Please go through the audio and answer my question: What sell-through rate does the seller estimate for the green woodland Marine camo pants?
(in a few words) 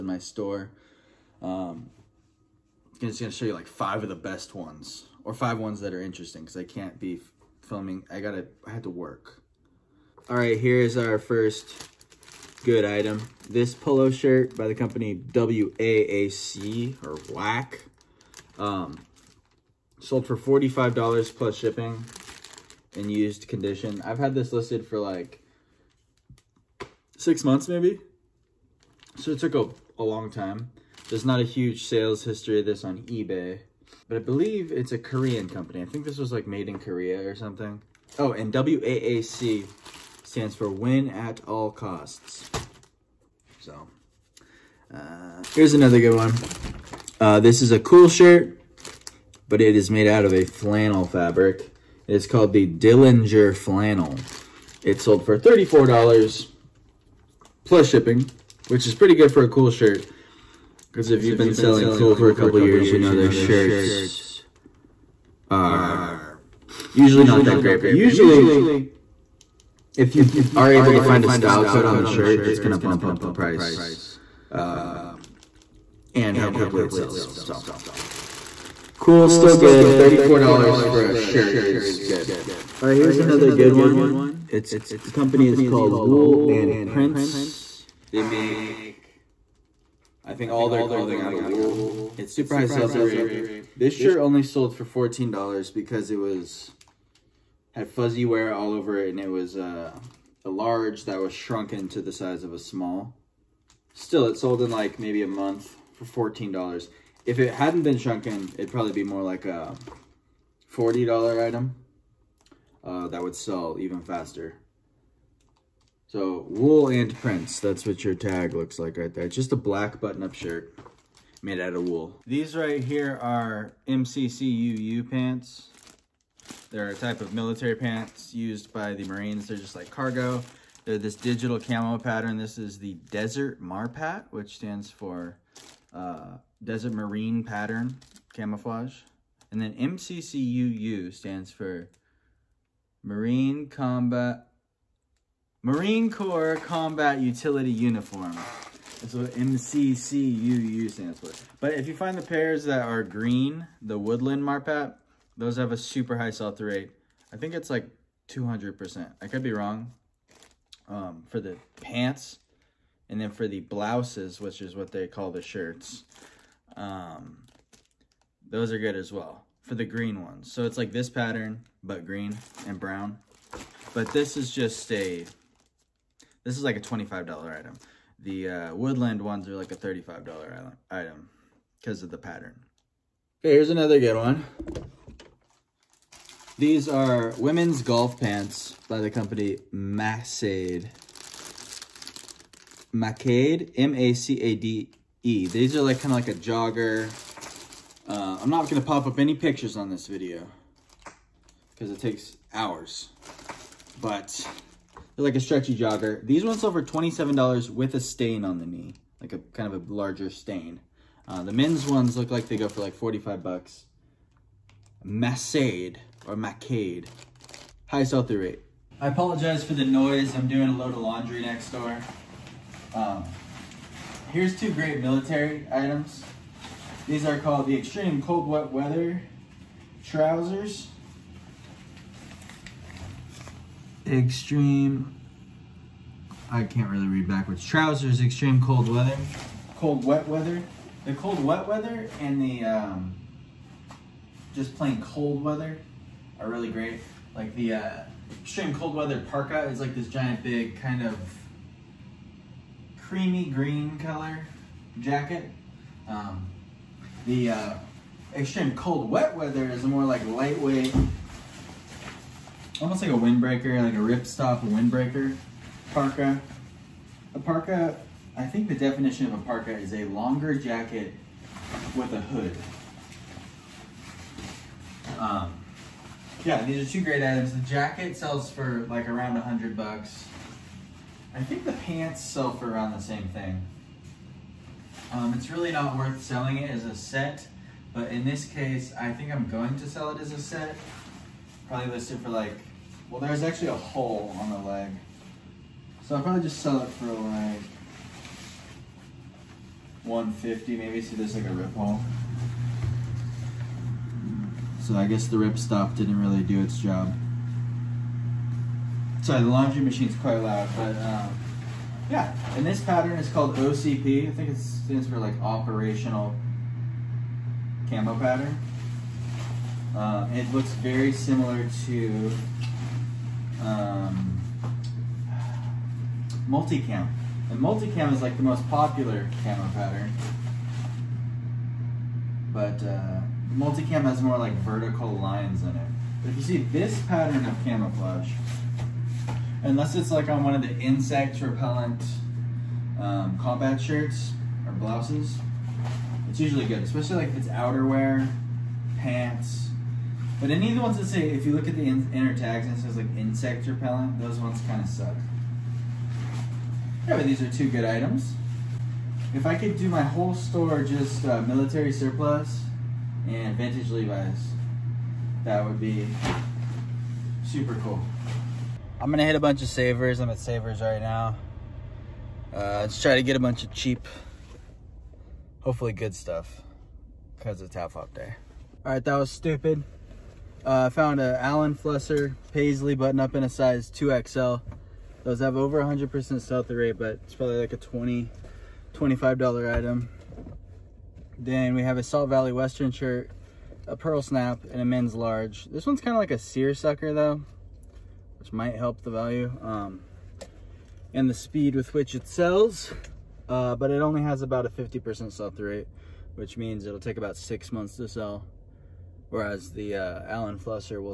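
200%.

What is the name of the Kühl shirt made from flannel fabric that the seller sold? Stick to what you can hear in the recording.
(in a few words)
Dillinger Flannel.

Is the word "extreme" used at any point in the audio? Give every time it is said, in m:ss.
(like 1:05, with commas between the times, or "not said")
3:47, 3:54, 3:58, 4:08, 4:18.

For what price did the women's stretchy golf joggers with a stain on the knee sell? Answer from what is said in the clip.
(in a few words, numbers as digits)
$27.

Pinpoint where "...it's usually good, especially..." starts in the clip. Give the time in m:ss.
5:46.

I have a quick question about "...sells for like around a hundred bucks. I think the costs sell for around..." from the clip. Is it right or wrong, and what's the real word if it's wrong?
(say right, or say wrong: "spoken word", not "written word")
wrong: "pants", not "costs".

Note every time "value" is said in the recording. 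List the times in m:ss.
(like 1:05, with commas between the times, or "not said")
6:39.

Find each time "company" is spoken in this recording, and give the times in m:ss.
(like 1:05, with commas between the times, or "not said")
0:14, 0:35, 1:25, 3:09.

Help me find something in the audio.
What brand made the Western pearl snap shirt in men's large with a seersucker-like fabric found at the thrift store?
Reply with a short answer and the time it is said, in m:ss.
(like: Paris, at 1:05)
Salt Valley, at 6:32.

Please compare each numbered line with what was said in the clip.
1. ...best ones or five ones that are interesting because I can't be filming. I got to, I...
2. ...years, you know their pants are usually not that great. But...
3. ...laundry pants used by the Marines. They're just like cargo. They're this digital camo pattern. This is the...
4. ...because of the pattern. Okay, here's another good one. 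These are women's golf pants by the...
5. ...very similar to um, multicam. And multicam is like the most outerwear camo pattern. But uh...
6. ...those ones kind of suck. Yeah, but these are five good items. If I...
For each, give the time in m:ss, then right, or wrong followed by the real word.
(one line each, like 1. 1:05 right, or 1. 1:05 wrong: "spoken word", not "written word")
1. 0:04 right
2. 1:02 wrong: "shirts", not "pants"
3. 2:07 wrong: "military", not "laundry"
4. 3:01 right
5. 5:20 wrong: "popular", not "outerwear"
6. 5:54 wrong: "two", not "five".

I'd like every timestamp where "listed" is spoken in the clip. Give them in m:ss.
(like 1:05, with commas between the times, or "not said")
0:24, 4:51.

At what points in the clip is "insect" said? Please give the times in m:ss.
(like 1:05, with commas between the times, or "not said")
5:40, 5:53.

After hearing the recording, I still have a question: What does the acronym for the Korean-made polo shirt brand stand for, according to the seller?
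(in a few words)
Win at all costs.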